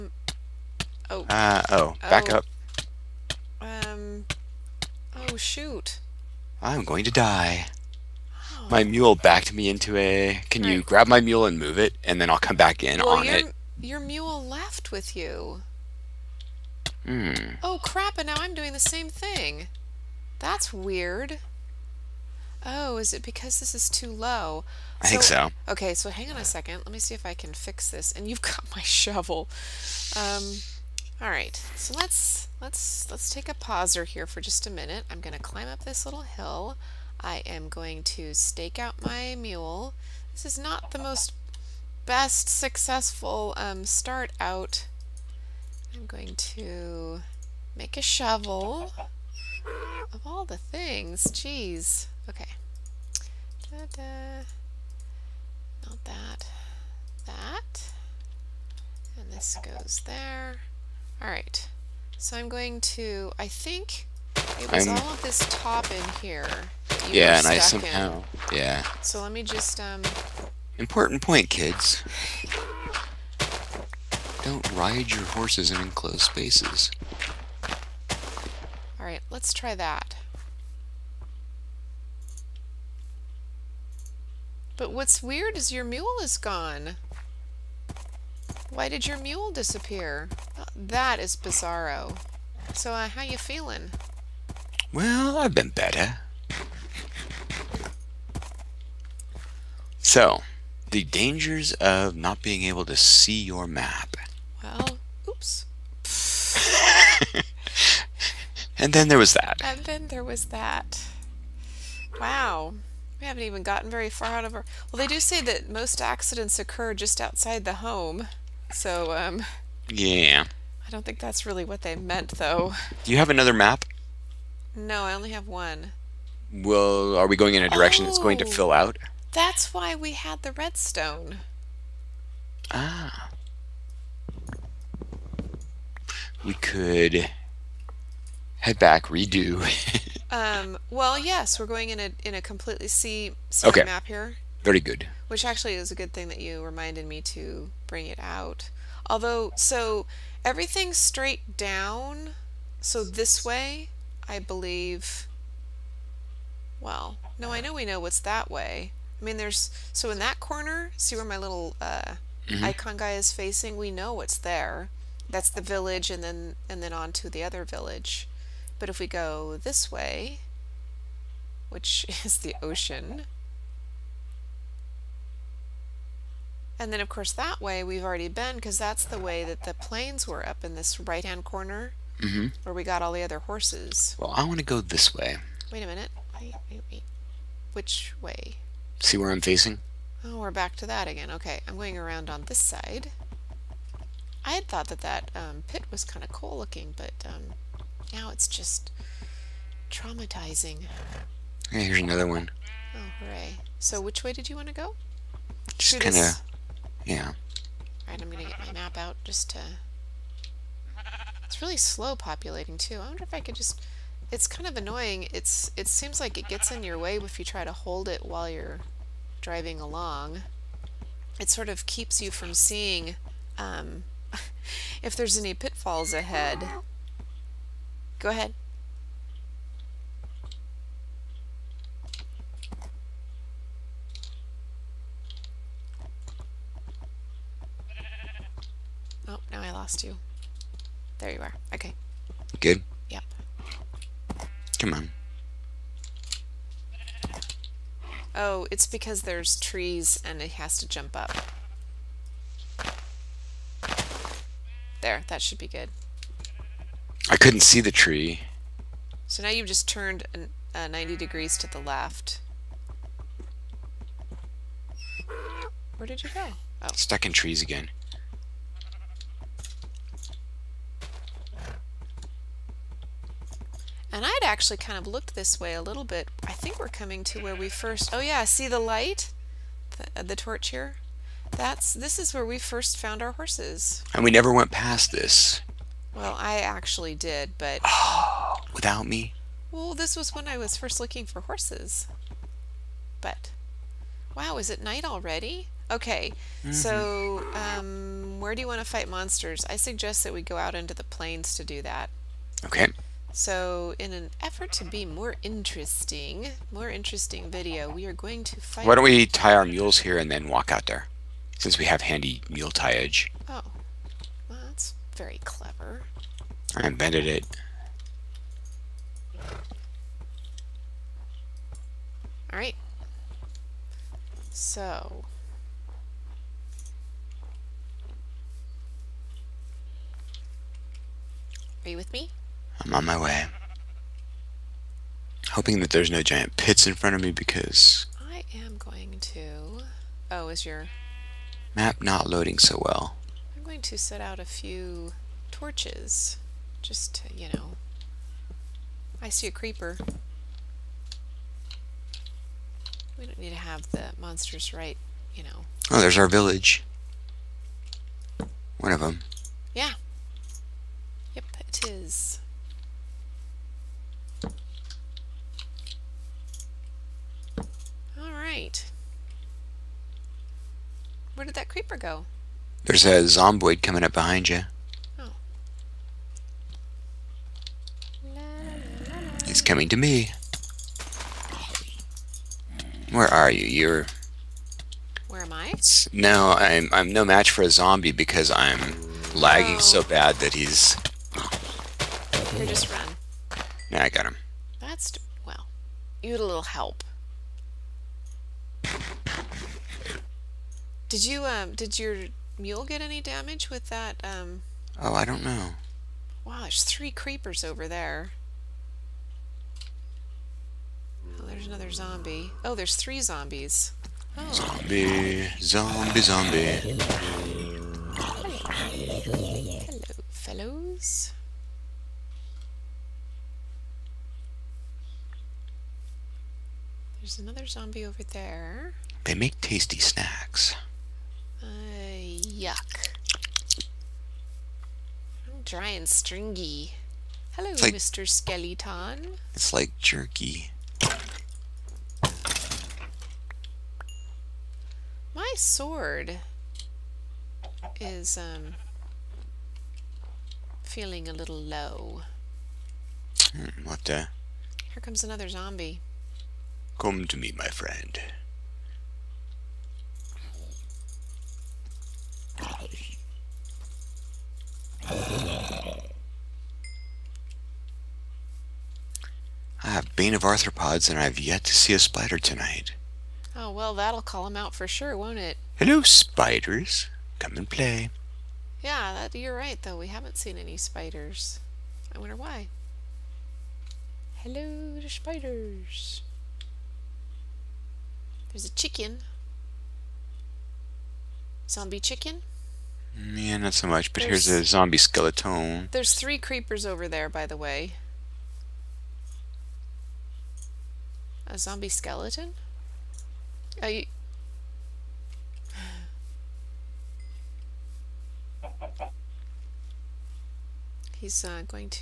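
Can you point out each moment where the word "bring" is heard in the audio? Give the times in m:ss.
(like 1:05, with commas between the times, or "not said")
2:27.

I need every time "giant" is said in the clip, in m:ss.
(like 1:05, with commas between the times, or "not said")
5:36.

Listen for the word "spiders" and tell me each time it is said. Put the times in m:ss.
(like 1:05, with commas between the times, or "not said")
7:51, 7:56, 8:00, 8:05.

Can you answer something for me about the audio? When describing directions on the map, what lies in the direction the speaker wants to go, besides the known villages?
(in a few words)
The ocean.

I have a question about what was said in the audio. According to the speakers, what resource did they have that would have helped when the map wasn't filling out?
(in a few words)
Redstone.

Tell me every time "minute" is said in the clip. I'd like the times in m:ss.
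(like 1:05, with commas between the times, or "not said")
0:34, 3:05.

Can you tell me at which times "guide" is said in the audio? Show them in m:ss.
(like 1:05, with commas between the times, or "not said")
not said.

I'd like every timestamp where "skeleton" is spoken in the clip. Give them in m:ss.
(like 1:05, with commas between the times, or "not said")
7:18, 8:14, 8:21.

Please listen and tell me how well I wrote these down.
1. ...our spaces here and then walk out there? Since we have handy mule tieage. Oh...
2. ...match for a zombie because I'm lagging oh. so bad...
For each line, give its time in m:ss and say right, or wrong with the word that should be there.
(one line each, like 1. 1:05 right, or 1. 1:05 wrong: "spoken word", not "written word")
1. 5:09 wrong: "mules", not "spaces"
2. 6:27 right.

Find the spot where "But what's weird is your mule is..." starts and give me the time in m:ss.
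1:24.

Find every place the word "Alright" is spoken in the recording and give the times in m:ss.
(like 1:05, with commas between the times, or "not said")
1:01, 3:28, 5:22.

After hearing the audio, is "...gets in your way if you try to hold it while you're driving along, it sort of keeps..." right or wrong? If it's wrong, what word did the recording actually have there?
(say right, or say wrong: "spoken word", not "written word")
right.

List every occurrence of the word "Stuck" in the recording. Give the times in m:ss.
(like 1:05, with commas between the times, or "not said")
4:26.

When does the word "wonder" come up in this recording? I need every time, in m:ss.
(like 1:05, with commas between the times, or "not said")
3:33, 8:02.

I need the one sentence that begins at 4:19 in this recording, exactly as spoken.
So now you've just turned an, uh, 90 degrees to the left.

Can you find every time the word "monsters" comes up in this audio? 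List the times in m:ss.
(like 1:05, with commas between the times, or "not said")
4:59, 5:54.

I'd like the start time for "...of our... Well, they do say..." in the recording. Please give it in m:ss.
1:54.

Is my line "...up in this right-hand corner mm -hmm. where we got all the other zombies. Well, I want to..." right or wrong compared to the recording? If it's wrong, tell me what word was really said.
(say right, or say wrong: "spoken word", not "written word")
wrong: "horses", not "zombies".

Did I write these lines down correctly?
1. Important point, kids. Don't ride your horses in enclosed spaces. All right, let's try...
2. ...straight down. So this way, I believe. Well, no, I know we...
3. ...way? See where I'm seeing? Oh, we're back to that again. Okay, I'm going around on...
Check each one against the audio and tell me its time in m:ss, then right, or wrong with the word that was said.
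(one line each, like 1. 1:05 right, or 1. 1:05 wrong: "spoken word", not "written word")
1. 1:10 right
2. 2:30 right
3. 3:08 wrong: "facing", not "seeing".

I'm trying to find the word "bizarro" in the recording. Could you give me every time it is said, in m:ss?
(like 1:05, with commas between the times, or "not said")
1:31.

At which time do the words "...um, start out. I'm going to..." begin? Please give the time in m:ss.
0:43.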